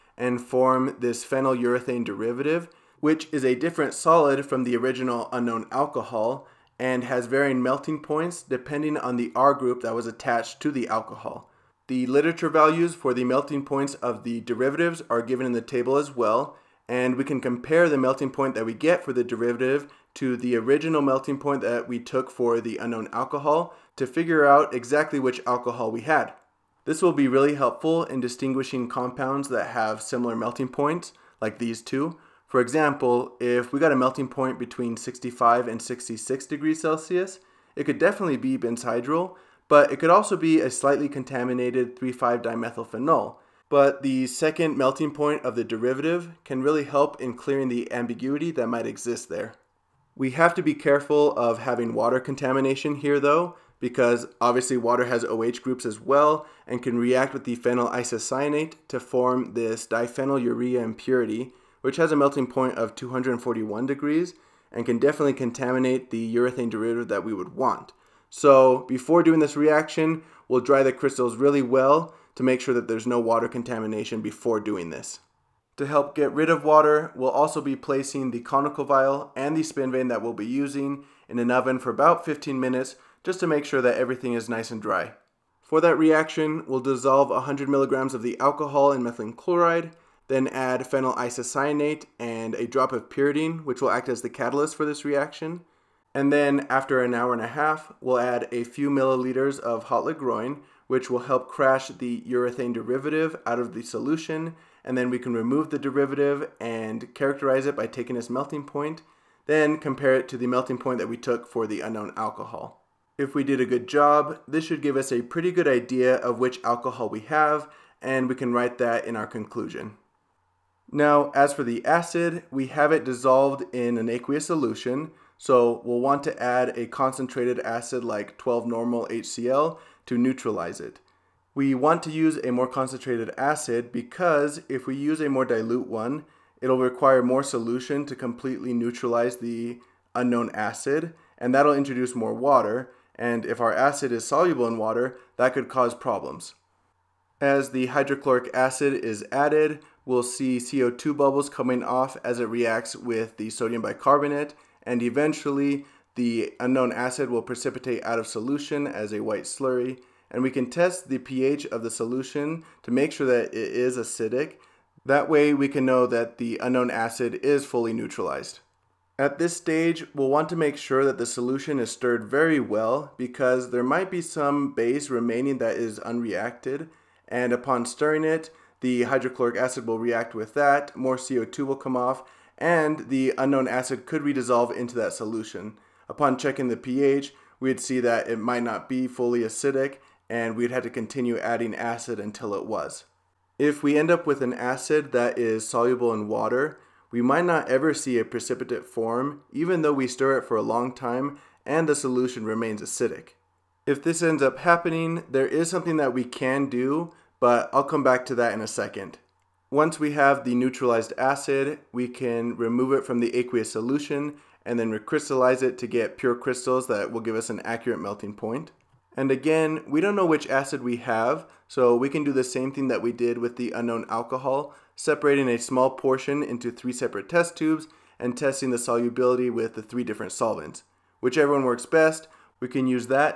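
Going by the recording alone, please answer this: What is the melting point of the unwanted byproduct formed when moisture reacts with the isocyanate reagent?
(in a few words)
241 degrees.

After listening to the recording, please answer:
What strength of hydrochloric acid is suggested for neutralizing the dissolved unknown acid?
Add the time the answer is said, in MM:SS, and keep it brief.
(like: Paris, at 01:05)
12 normal, at 02:08.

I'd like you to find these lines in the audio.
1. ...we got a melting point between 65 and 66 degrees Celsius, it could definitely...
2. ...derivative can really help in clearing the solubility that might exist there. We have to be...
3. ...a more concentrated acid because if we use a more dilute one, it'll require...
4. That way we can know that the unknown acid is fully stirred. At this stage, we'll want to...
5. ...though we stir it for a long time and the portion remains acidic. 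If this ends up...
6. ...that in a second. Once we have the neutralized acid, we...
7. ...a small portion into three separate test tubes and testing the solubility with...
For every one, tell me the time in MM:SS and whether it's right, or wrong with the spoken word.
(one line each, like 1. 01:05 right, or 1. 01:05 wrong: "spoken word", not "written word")
1. 00:33 right
2. 00:45 wrong: "ambiguity", not "solubility"
3. 02:12 right
4. 02:45 wrong: "neutralized", not "stirred"
5. 03:19 wrong: "solution", not "portion"
6. 03:28 right
7. 03:45 right.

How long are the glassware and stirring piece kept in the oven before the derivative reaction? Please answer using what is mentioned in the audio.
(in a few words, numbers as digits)
15 minutes.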